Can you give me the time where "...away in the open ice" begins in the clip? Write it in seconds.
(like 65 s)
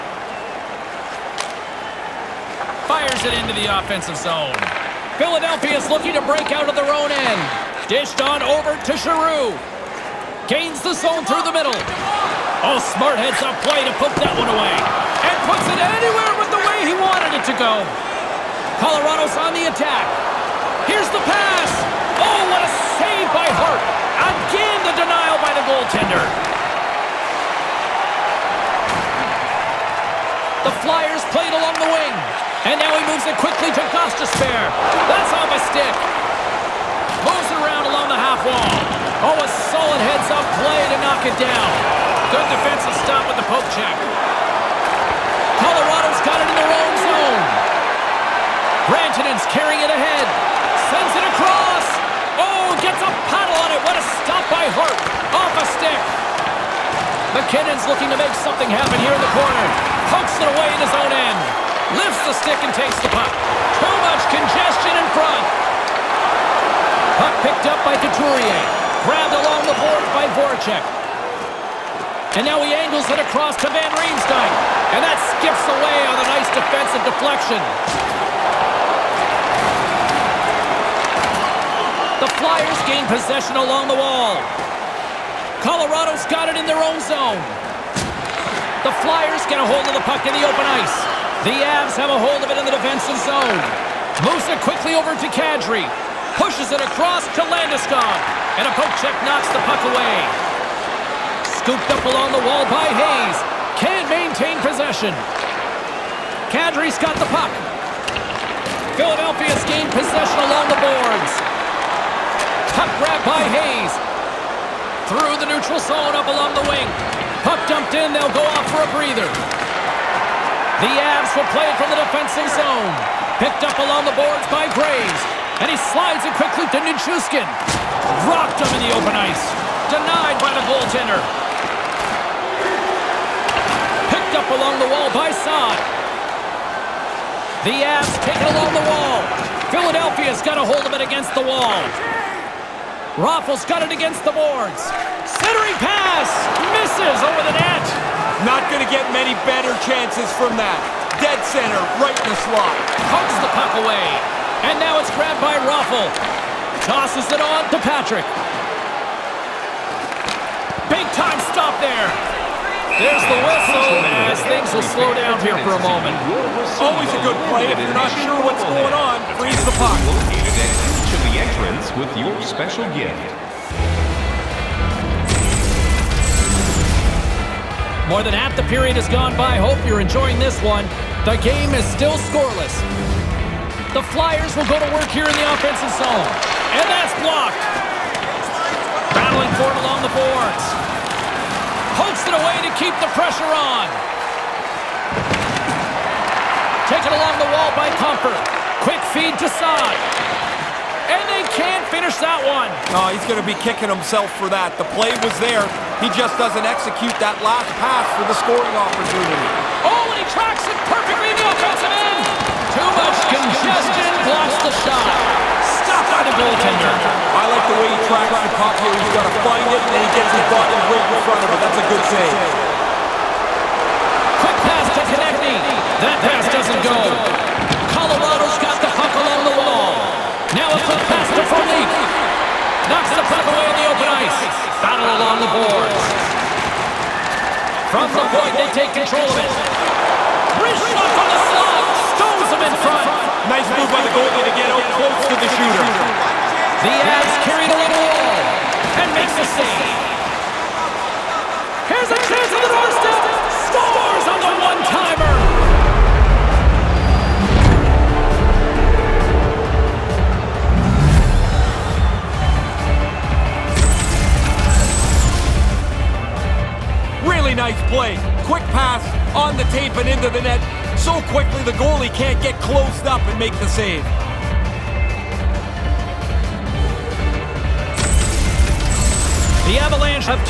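233 s.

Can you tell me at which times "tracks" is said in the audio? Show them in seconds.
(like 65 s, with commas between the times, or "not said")
210 s, 218 s.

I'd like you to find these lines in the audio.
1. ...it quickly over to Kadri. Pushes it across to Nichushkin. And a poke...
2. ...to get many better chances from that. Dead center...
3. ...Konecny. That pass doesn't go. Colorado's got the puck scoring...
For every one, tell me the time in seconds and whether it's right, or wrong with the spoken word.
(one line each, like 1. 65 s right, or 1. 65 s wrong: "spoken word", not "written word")
1. 94 s wrong: "Landeskog", not "Nichushkin"
2. 148 s right
3. 225 s wrong: "along", not "scoring".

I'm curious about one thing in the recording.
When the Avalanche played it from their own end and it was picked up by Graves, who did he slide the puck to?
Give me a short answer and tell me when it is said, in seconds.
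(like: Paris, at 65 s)
Nichushkin, at 126 s.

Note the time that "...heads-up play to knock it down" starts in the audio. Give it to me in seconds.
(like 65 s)
40 s.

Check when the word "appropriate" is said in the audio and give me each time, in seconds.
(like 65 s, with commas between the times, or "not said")
not said.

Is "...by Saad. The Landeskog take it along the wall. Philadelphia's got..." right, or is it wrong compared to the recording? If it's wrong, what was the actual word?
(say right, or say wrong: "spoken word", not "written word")
wrong: "Avs", not "Landeskog".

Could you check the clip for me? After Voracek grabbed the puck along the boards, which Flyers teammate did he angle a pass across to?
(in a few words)
Van Riemsdyk.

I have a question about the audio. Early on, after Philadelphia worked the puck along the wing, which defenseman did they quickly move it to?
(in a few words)
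Gostisbehere.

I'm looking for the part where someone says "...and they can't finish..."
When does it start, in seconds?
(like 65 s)
201 s.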